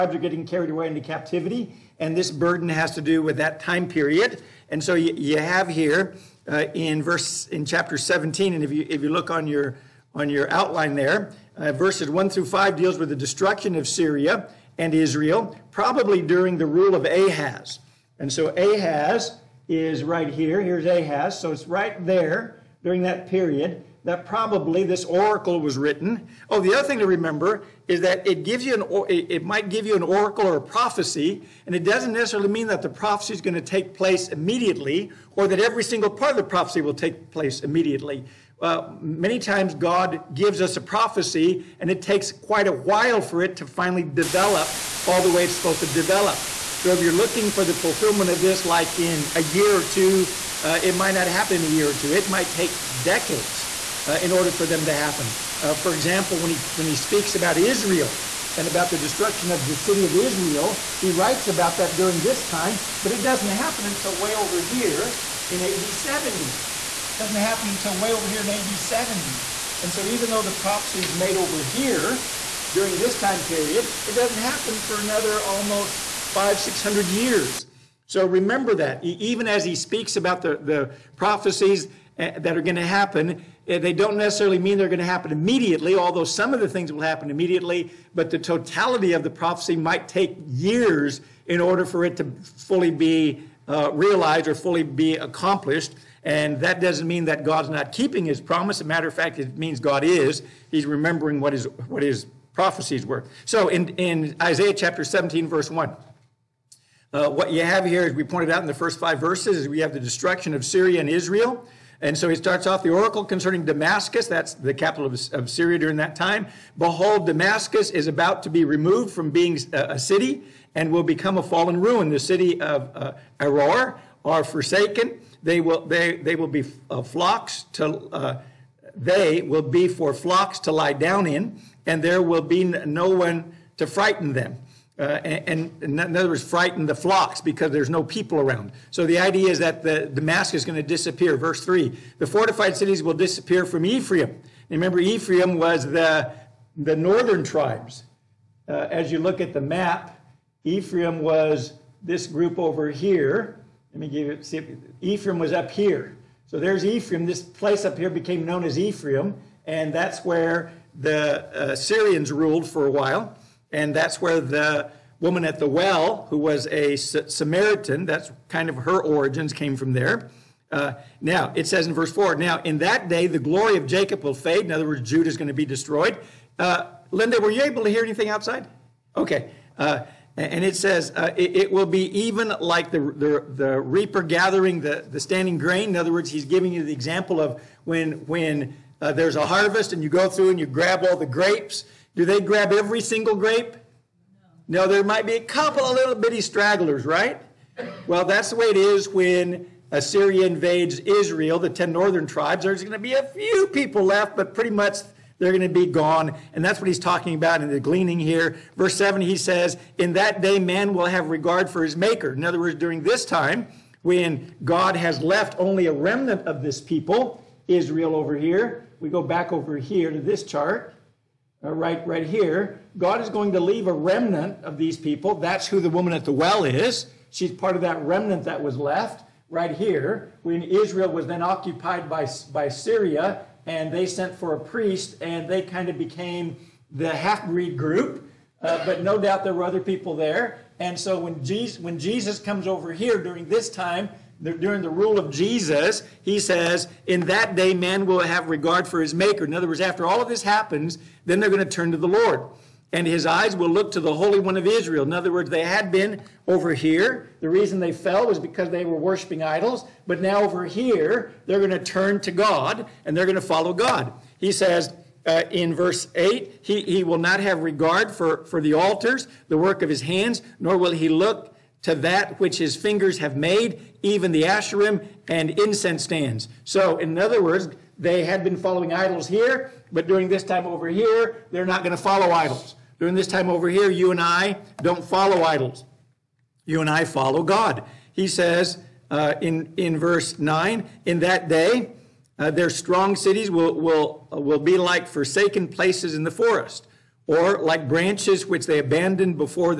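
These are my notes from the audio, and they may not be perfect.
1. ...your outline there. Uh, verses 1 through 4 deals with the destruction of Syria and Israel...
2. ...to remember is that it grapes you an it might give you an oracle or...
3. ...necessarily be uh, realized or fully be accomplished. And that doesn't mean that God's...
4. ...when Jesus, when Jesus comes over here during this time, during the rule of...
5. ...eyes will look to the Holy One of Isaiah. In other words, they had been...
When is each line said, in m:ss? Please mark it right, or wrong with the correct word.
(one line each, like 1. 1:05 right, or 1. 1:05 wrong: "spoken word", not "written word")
1. 0:10 wrong: "5", not "4"
2. 0:26 wrong: "gives", not "grapes"
3. 1:32 wrong: "fully", not "necessarily"
4. 4:01 right
5. 4:13 wrong: "Israel", not "Isaiah".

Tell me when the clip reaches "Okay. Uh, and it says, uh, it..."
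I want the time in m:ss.
2:59.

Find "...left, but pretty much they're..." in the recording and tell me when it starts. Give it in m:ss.
3:24.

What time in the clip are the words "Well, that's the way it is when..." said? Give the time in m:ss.
3:18.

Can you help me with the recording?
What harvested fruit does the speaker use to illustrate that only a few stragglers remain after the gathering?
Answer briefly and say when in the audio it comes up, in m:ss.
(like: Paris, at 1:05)
grapes, at 3:11.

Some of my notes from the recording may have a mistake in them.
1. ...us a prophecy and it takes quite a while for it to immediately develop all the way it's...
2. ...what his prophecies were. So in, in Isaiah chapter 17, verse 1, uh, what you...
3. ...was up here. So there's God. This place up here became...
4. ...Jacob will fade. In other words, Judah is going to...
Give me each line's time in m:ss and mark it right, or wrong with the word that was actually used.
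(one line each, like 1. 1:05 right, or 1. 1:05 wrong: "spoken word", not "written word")
1. 0:40 wrong: "finally", not "immediately"
2. 1:41 right
3. 2:35 wrong: "Ephraim", not "God"
4. 2:53 right.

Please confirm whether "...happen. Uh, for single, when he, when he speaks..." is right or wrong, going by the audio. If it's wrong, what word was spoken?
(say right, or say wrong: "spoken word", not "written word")
wrong: "example", not "single".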